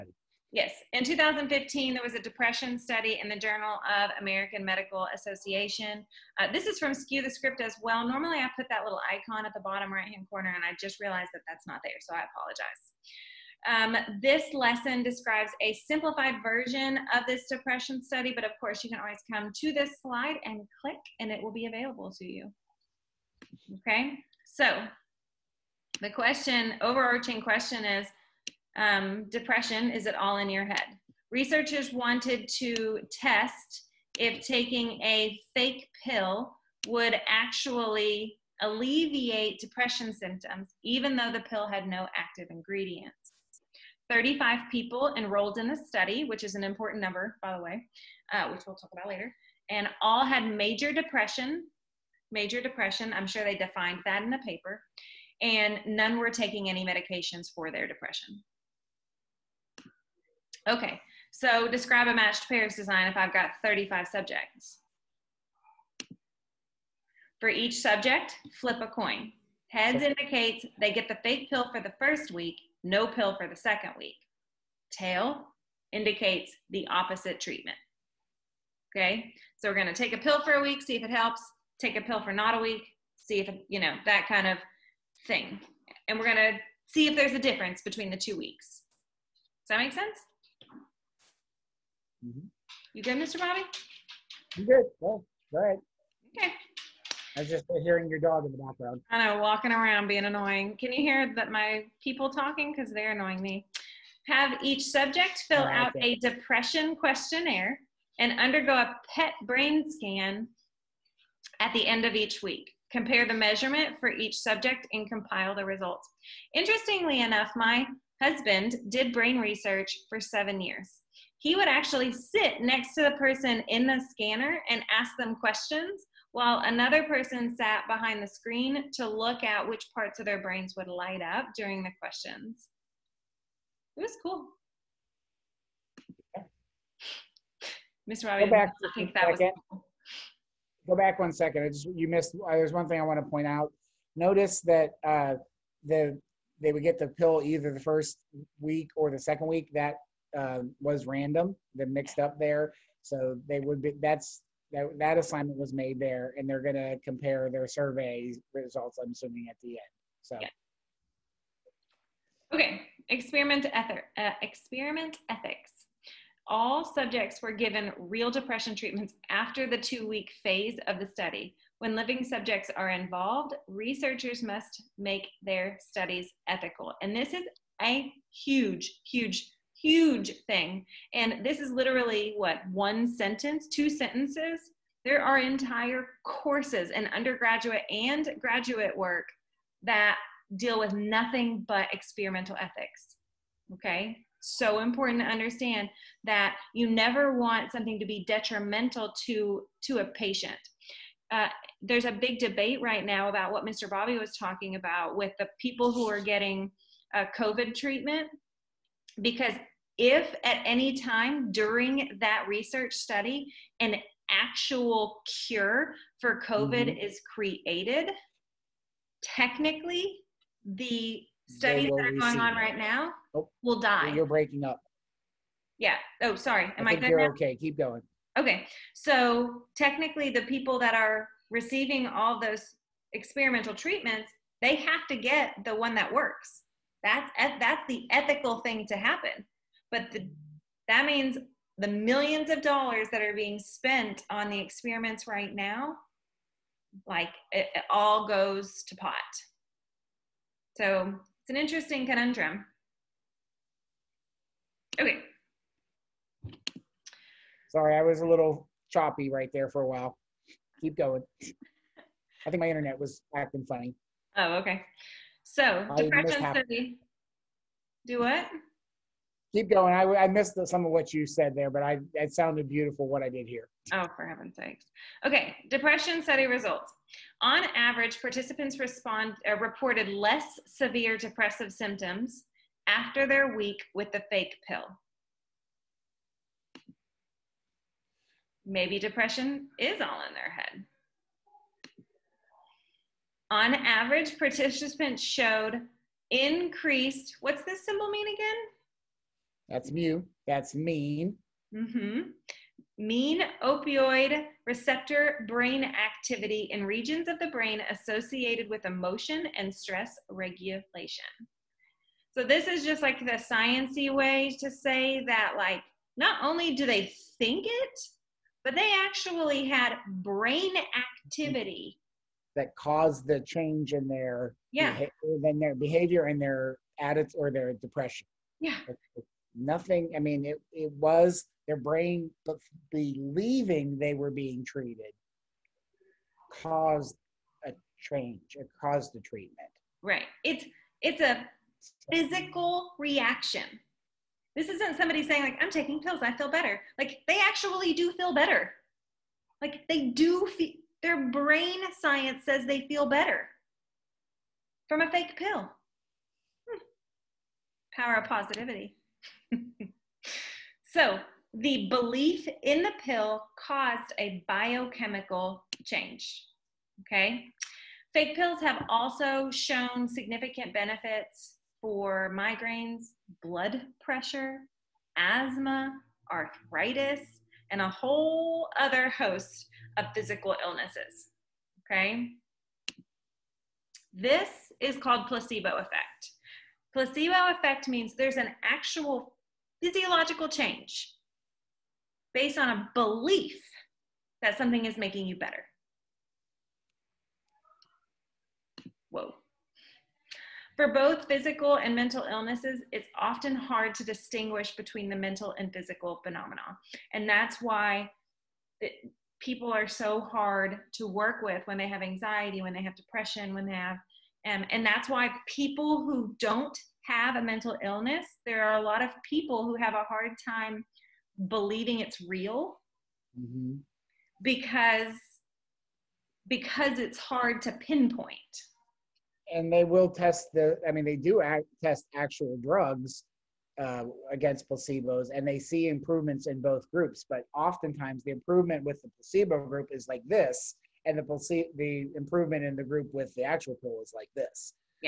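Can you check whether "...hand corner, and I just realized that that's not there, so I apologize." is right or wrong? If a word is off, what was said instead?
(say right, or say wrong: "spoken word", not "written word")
right.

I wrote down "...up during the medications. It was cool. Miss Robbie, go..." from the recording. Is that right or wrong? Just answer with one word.
wrong.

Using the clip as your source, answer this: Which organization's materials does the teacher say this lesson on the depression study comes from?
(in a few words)
Skew the Script.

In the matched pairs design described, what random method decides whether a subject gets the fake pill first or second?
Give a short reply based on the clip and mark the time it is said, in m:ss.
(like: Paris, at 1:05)
Flip a coin, at 1:08.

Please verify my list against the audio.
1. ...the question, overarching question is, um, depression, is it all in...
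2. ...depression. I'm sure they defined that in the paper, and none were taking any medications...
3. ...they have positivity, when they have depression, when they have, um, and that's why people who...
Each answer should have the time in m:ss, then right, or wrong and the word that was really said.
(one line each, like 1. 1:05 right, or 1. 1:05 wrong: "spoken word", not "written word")
1. 0:26 right
2. 0:52 right
3. 6:51 wrong: "anxiety", not "positivity".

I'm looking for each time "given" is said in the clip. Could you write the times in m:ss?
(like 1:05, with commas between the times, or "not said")
2:47.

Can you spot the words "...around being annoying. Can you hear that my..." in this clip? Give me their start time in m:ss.
1:39.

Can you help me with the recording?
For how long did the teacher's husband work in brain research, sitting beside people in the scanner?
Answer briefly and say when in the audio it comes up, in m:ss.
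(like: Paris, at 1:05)
7 years, at 2:00.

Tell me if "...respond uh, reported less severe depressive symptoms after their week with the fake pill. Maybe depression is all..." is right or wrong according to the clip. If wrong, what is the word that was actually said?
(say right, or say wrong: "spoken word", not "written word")
right.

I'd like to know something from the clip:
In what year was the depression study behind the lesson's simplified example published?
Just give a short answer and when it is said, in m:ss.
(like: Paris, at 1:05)
2015, at 0:01.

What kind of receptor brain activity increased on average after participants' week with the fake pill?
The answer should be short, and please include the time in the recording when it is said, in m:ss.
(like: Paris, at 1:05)
Opioid receptor, at 5:03.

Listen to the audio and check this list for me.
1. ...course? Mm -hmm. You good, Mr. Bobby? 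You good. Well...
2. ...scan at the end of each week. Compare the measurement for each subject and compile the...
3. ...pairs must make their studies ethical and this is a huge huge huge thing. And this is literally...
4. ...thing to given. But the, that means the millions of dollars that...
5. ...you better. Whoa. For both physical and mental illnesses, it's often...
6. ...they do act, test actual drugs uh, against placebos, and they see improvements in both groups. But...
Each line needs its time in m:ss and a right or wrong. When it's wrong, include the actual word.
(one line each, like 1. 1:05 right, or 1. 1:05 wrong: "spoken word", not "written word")
1. 1:29 wrong: "sense", not "course"
2. 1:49 right
3. 2:53 wrong: "researchers", not "pairs"
4. 3:58 wrong: "happen", not "given"
5. 6:35 right
6. 7:11 right.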